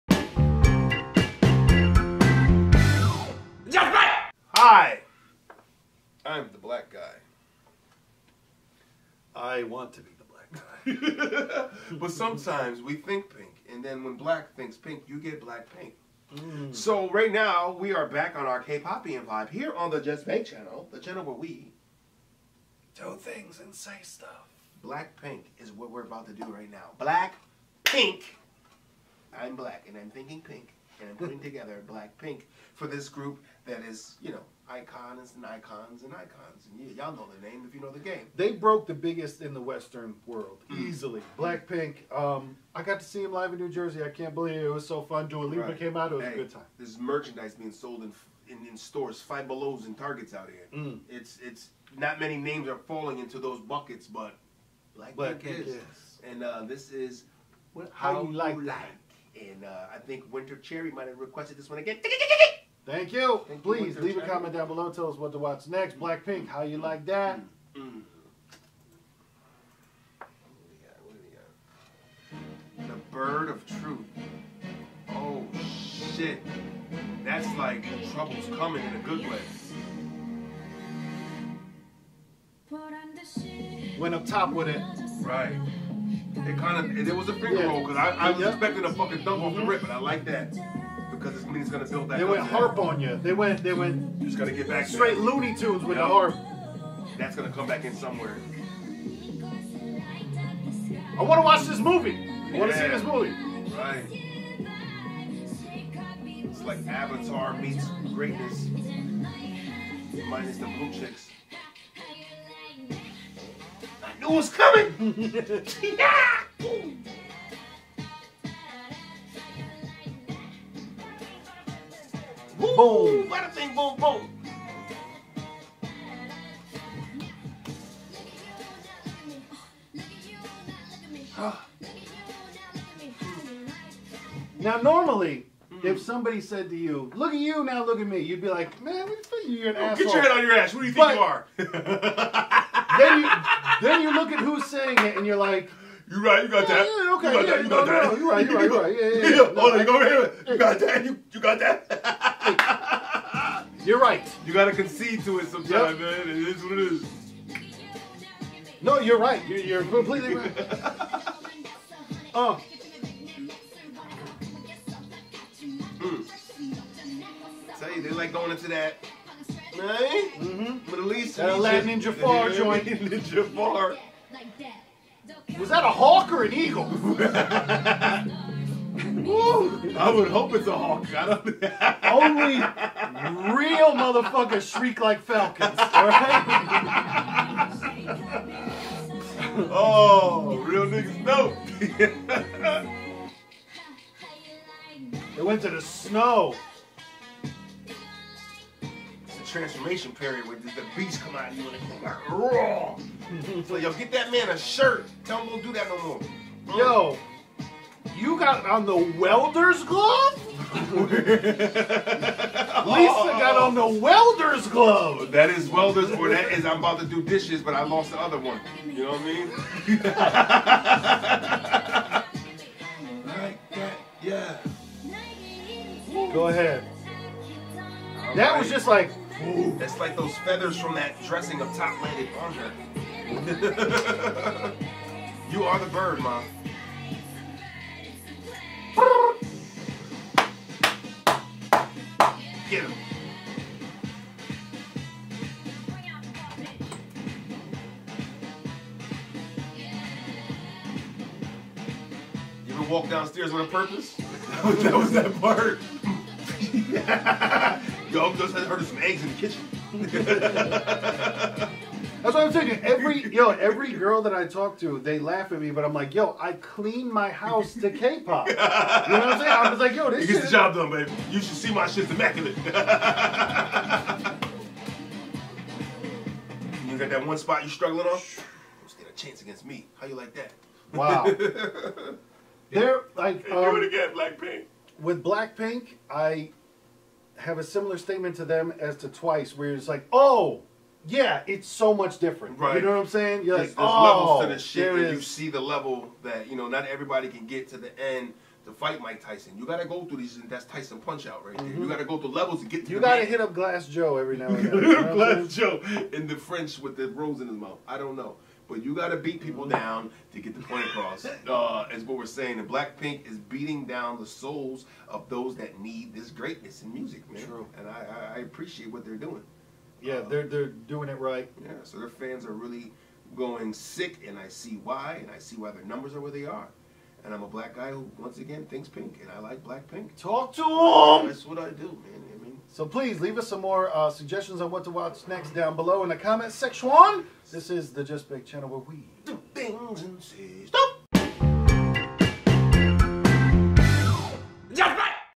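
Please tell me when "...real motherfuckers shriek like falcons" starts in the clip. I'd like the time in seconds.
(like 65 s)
183 s.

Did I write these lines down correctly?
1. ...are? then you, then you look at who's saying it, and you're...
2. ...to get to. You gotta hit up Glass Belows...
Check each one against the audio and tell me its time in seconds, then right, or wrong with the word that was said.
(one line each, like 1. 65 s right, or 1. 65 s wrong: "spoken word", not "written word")
1. 141 s right
2. 302 s wrong: "Joe", not "Belows".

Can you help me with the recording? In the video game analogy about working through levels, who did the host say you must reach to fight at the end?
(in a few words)
Mike Tyson.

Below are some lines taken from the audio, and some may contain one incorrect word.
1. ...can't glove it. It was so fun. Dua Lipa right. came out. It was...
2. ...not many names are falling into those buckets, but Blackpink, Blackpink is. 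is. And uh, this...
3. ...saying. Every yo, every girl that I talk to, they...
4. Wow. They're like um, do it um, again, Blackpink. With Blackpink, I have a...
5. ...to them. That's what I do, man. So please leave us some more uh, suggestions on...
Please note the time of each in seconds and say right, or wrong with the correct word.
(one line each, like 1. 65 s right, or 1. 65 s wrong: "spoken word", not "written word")
1. 44 s wrong: "believe", not "glove"
2. 51 s right
3. 262 s right
4. 280 s right
5. 330 s right.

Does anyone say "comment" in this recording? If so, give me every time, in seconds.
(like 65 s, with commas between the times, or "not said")
64 s, 336 s.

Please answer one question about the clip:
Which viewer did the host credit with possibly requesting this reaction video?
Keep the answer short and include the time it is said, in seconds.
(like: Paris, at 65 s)
Winter Cherry, at 60 s.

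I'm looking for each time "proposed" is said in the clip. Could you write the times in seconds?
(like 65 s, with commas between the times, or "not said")
not said.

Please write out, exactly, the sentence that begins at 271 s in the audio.
You should see my shit's immaculate.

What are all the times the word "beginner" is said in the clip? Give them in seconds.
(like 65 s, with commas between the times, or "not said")
not said.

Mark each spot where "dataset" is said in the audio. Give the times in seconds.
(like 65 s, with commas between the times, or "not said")
not said.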